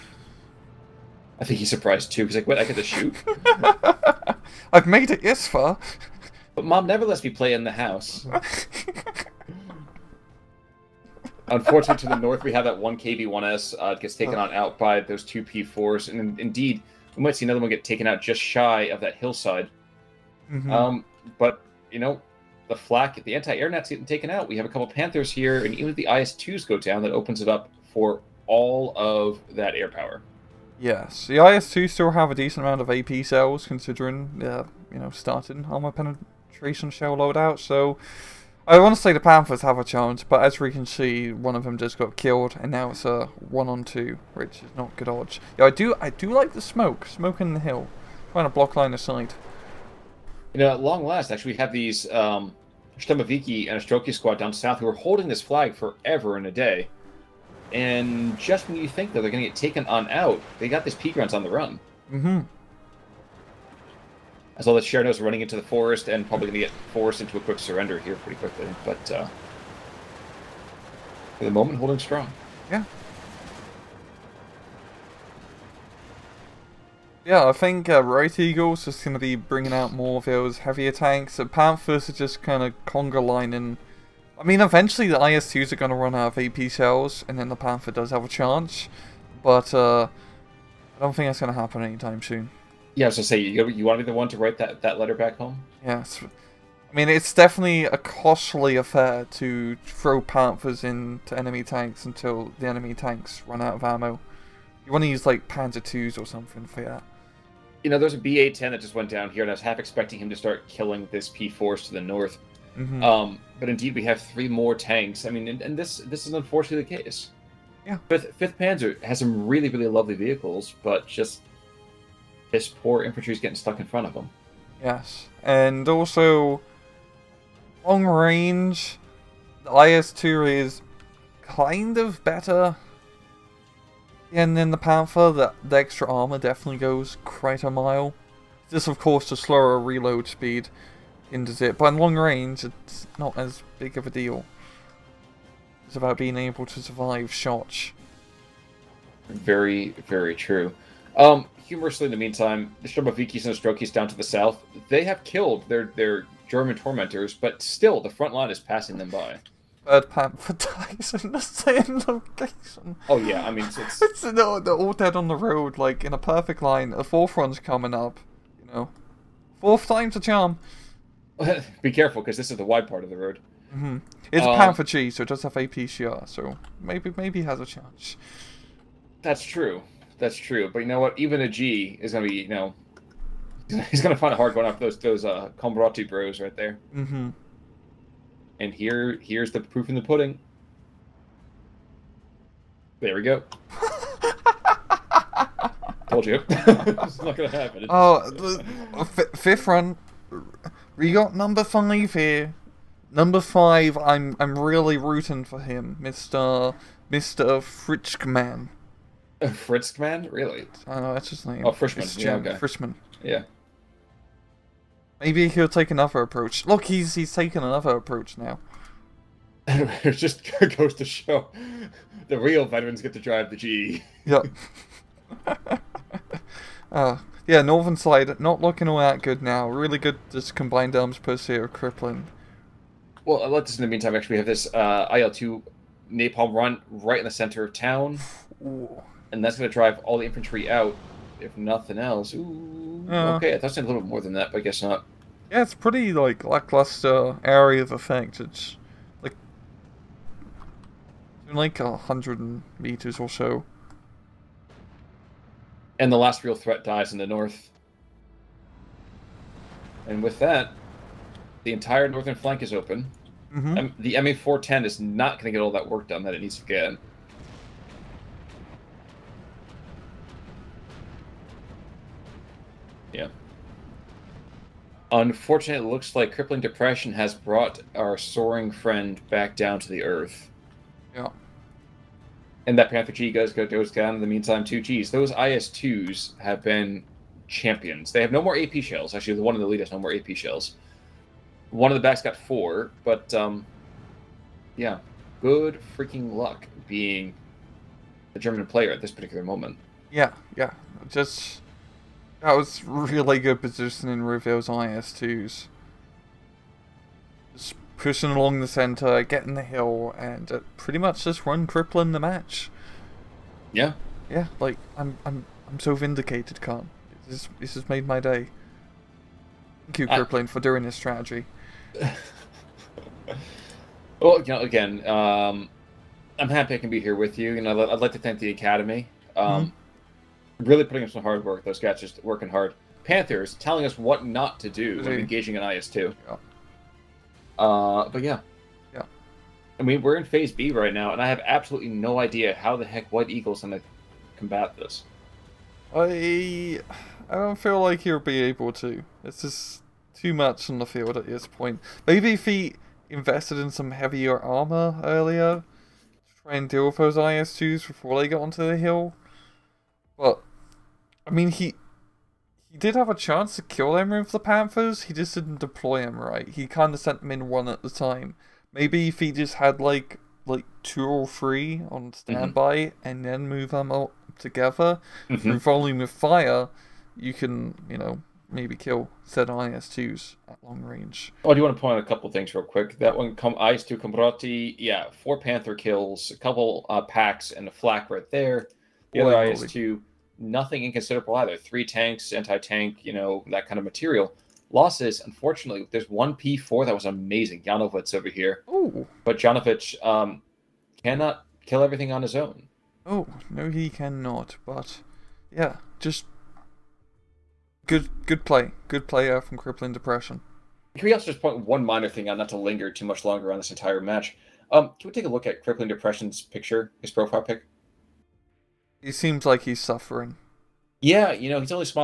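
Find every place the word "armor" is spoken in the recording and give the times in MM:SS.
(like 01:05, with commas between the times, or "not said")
00:35, 02:16, 05:54.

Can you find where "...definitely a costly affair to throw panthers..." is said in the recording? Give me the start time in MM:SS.
01:37.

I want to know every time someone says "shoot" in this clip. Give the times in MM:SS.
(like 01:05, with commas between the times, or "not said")
00:02.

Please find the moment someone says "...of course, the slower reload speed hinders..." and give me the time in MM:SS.
02:18.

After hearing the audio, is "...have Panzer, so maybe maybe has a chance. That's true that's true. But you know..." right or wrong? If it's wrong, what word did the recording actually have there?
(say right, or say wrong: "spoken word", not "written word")
wrong: "APCR", not "Panzer".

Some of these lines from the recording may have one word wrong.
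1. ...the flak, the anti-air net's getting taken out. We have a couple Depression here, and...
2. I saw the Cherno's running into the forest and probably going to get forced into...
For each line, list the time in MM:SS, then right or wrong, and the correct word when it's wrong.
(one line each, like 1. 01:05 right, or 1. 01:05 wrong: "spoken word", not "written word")
1. 00:22 wrong: "Panthers", not "Depression"
2. 01:04 right.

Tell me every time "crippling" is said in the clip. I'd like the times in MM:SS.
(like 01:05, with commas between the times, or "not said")
03:51, 04:36, 05:11, 05:20, 06:49, 06:55.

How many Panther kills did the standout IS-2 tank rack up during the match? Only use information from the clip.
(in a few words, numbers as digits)
4.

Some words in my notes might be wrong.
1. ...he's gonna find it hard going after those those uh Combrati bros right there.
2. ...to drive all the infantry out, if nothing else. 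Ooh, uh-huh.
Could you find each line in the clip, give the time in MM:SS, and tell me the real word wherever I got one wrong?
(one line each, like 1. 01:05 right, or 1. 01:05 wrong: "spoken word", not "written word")
1. 03:03 right
2. 03:59 right.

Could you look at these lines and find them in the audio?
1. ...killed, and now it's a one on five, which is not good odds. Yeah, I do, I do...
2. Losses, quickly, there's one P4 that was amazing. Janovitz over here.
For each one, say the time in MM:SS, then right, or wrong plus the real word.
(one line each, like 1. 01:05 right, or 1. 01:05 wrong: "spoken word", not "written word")
1. 00:42 wrong: "two", not "five"
2. 06:34 wrong: "unfortunately", not "quickly".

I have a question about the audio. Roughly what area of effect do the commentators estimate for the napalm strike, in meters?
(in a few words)
100.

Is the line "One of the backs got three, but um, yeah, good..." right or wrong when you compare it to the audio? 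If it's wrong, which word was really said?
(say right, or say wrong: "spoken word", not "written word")
wrong: "four", not "three".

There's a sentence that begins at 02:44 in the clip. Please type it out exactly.
they're, all dead on the road, like in a perfect line.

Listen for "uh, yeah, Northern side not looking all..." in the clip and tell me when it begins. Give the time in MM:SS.
03:46.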